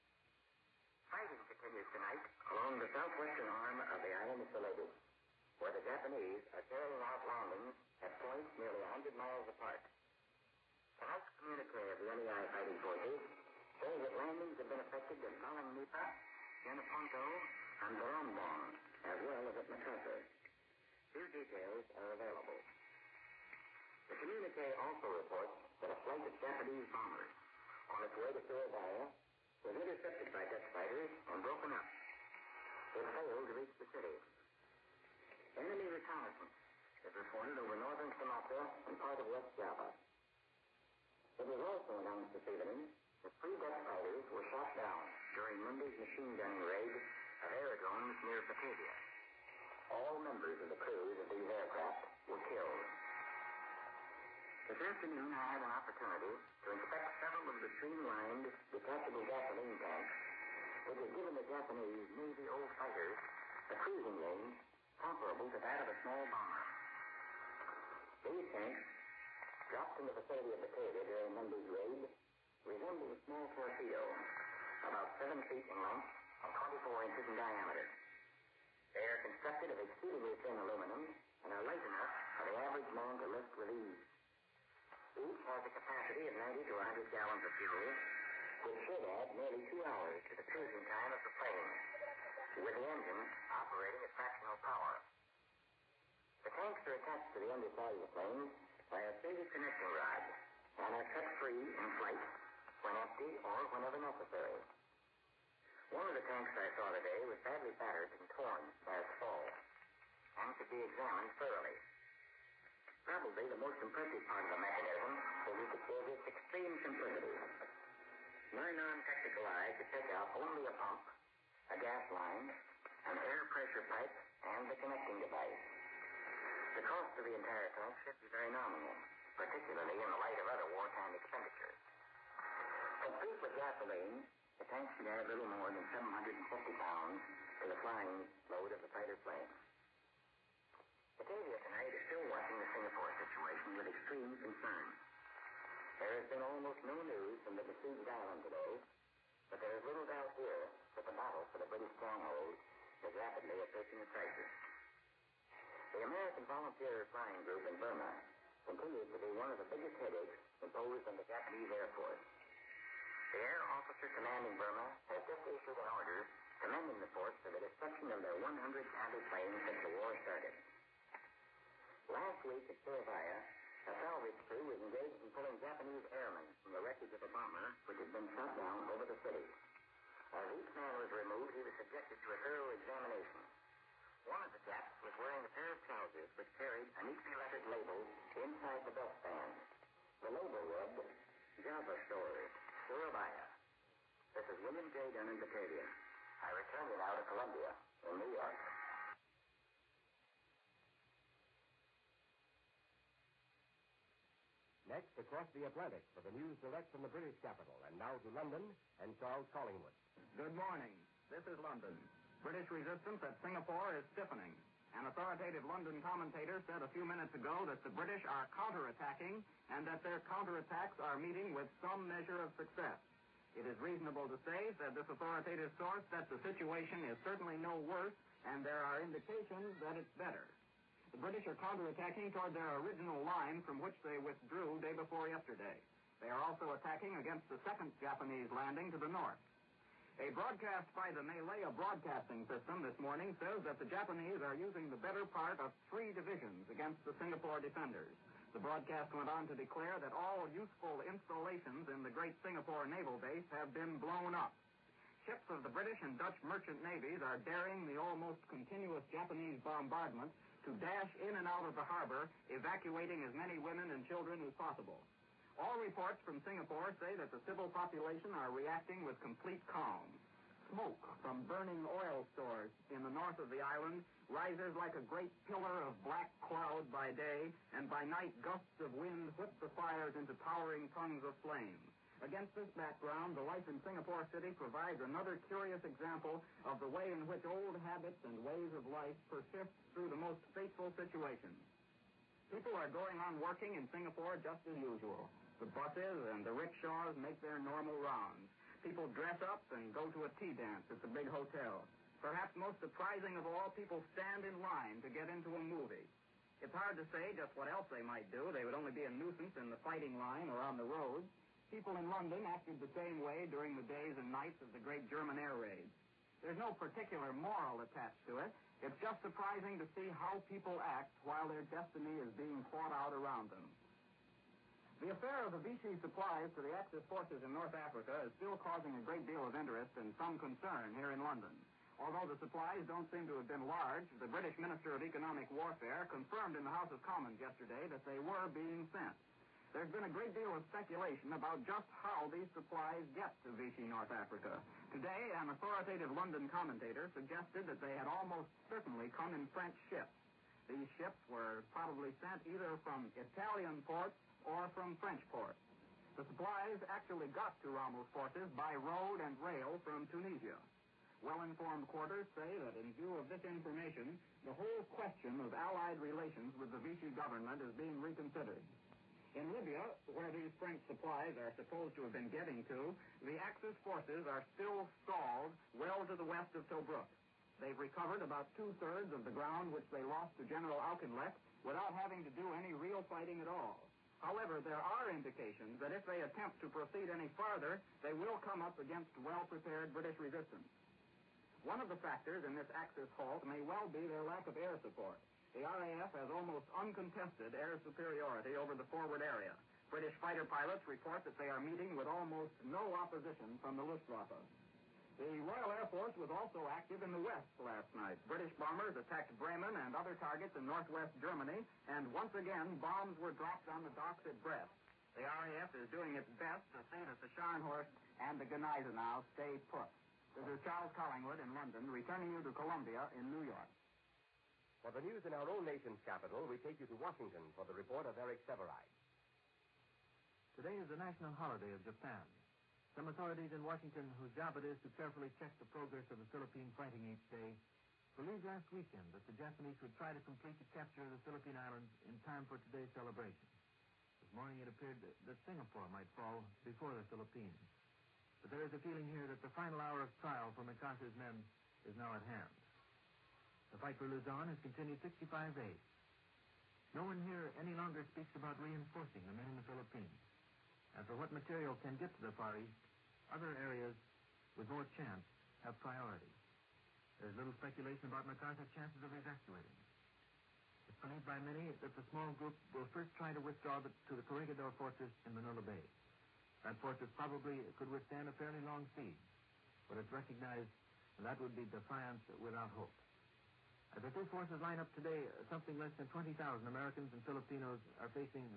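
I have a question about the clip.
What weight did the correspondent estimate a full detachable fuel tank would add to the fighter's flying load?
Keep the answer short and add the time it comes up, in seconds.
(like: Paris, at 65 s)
750 pounds, at 135 s.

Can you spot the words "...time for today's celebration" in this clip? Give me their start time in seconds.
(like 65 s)
442 s.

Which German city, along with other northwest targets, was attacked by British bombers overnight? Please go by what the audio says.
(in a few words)
Bremen.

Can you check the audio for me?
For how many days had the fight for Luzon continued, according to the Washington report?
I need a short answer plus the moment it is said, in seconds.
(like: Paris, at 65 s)
65, at 455 s.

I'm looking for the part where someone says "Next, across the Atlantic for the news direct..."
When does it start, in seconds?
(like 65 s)
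204 s.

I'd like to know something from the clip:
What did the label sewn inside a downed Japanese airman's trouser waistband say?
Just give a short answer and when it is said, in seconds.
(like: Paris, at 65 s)
Java Story, Surabaya, at 191 s.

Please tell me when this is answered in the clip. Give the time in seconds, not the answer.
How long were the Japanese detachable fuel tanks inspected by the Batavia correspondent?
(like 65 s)
75 s.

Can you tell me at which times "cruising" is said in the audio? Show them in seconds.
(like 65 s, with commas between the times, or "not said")
63 s, 90 s.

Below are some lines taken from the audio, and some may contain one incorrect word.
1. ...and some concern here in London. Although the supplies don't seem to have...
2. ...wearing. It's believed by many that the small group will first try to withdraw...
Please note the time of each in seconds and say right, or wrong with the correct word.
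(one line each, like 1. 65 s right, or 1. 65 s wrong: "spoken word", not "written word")
1. 329 s right
2. 469 s wrong: "evacuating", not "wearing".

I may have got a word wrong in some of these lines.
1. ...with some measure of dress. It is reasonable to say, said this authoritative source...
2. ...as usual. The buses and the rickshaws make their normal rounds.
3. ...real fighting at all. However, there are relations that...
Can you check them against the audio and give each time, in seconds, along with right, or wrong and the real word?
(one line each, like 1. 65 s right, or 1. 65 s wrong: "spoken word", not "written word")
1. 221 s wrong: "success", not "dress"
2. 294 s right
3. 382 s wrong: "indications", not "relations".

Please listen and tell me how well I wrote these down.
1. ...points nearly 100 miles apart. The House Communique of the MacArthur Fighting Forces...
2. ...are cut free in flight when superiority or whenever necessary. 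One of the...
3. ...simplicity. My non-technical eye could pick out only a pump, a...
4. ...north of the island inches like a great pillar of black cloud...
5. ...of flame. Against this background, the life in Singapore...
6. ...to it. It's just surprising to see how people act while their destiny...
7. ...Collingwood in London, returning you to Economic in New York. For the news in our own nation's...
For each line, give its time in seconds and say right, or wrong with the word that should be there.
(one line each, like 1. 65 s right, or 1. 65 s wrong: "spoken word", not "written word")
1. 8 s wrong: "NEI", not "MacArthur"
2. 101 s wrong: "empty", not "superiority"
3. 116 s right
4. 273 s wrong: "rises", not "inches"
5. 281 s right
6. 318 s right
7. 420 s wrong: "Columbia", not "Economic".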